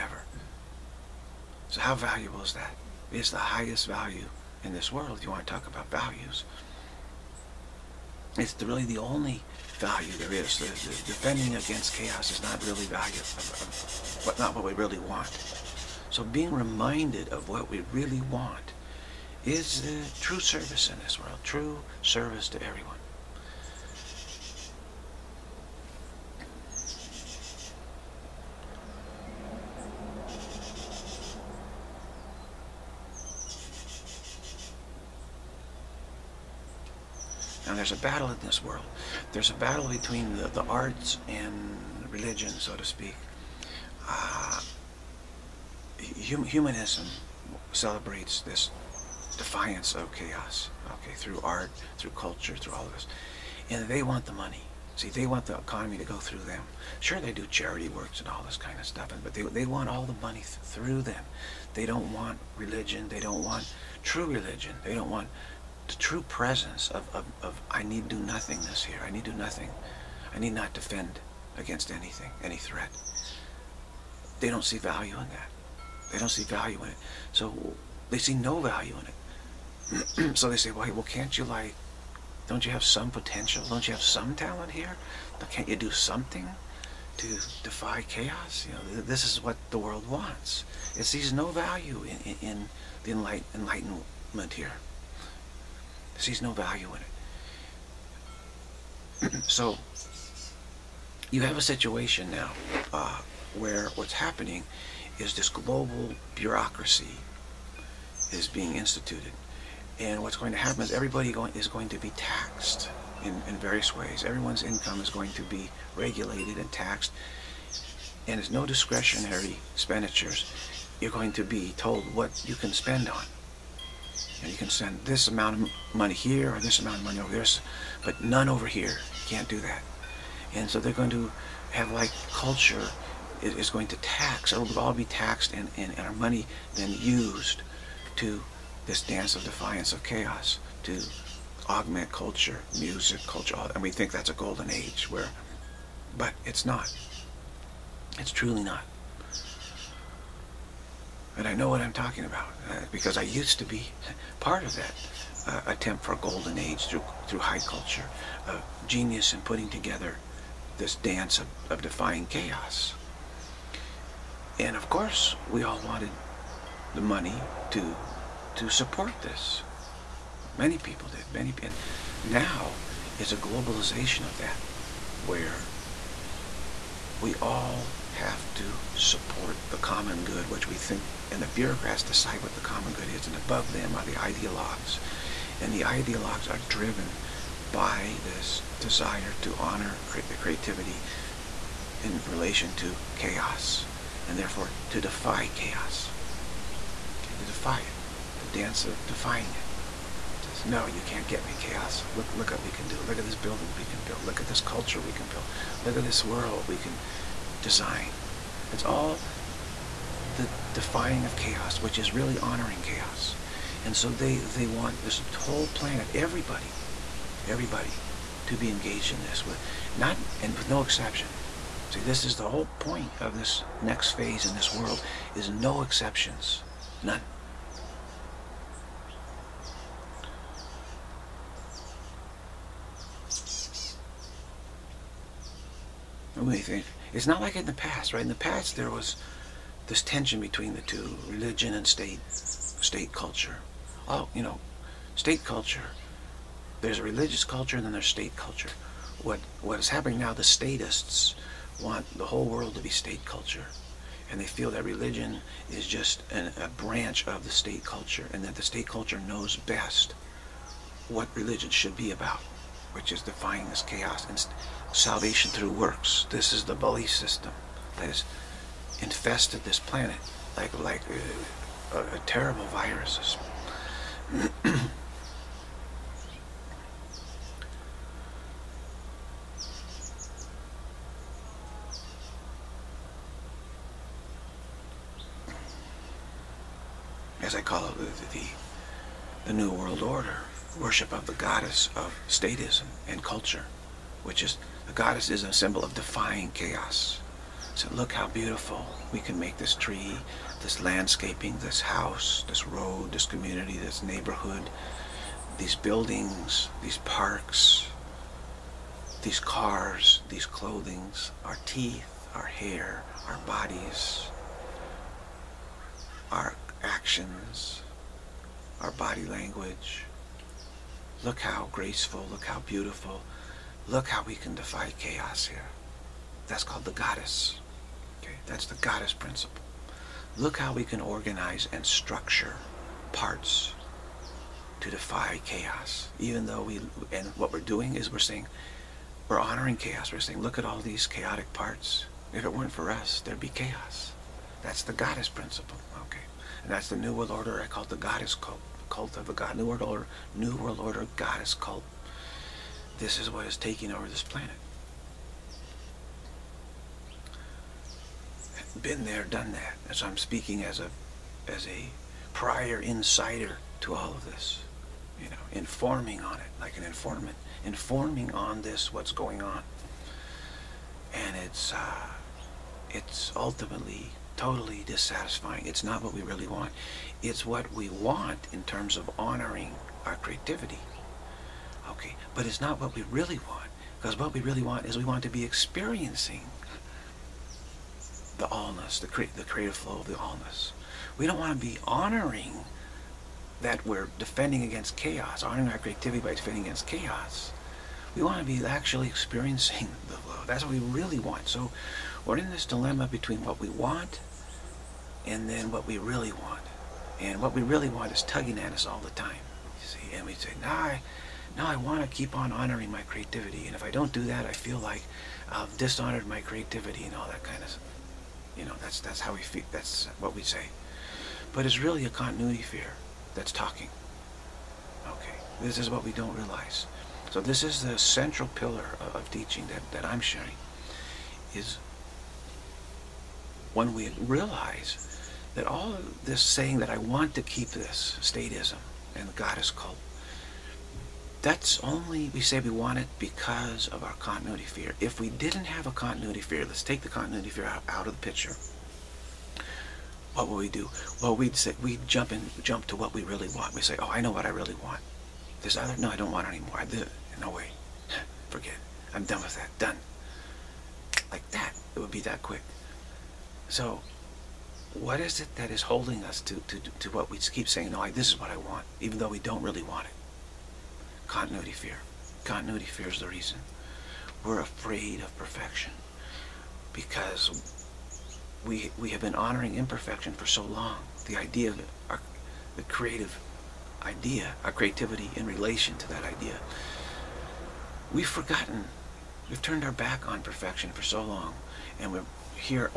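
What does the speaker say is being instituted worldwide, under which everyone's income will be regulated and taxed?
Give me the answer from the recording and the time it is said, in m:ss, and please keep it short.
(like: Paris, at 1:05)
Global bureaucracy, at 1:45.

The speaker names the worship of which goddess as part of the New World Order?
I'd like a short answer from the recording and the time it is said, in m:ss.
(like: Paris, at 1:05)
The goddess of statism, at 4:51.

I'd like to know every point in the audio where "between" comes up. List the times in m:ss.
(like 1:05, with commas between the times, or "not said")
0:39, 4:00, 6:43.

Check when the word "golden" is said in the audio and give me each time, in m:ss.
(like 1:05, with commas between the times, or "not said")
2:24, 2:36.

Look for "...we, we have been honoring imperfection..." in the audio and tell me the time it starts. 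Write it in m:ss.
7:58.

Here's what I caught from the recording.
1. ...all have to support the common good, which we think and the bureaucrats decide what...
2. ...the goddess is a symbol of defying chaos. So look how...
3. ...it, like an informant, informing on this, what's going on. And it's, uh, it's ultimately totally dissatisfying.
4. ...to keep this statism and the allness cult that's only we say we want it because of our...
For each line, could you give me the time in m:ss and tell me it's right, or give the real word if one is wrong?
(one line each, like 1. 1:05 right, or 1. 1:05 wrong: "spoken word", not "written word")
1. 2:57 right
2. 4:54 right
3. 6:06 right
4. 7:17 wrong: "goddess", not "allness".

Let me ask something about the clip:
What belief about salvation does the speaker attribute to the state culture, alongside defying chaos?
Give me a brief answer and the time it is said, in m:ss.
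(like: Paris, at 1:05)
Salvation through works, at 4:24.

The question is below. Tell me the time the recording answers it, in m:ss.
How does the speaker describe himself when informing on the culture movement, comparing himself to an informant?
6:02.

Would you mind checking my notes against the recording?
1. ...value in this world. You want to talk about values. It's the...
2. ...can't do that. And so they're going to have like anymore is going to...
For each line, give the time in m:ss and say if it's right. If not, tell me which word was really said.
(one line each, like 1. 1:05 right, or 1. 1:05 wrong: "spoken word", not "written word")
1. 0:03 right
2. 2:09 wrong: "culture", not "anymore".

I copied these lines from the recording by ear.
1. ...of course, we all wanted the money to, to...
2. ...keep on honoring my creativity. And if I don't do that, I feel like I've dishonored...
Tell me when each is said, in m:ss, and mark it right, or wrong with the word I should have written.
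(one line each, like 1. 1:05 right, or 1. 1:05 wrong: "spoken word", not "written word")
1. 2:44 right
2. 6:52 right.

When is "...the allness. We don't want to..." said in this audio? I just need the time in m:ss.
6:30.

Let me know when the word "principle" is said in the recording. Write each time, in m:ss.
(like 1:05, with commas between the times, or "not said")
5:29, 5:45.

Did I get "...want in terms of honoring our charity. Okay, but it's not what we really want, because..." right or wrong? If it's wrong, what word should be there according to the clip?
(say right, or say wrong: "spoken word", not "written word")
wrong: "creativity", not "charity".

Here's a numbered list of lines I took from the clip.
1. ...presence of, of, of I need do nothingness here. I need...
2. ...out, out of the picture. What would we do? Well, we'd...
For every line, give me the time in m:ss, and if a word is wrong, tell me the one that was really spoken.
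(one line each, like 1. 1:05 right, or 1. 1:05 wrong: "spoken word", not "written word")
1. 1:06 right
2. 7:27 right.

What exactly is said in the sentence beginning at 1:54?
Everyone's income is going to be regulated and taxed.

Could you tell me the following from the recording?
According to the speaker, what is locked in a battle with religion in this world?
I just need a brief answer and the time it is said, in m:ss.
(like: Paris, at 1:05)
The arts, at 0:40.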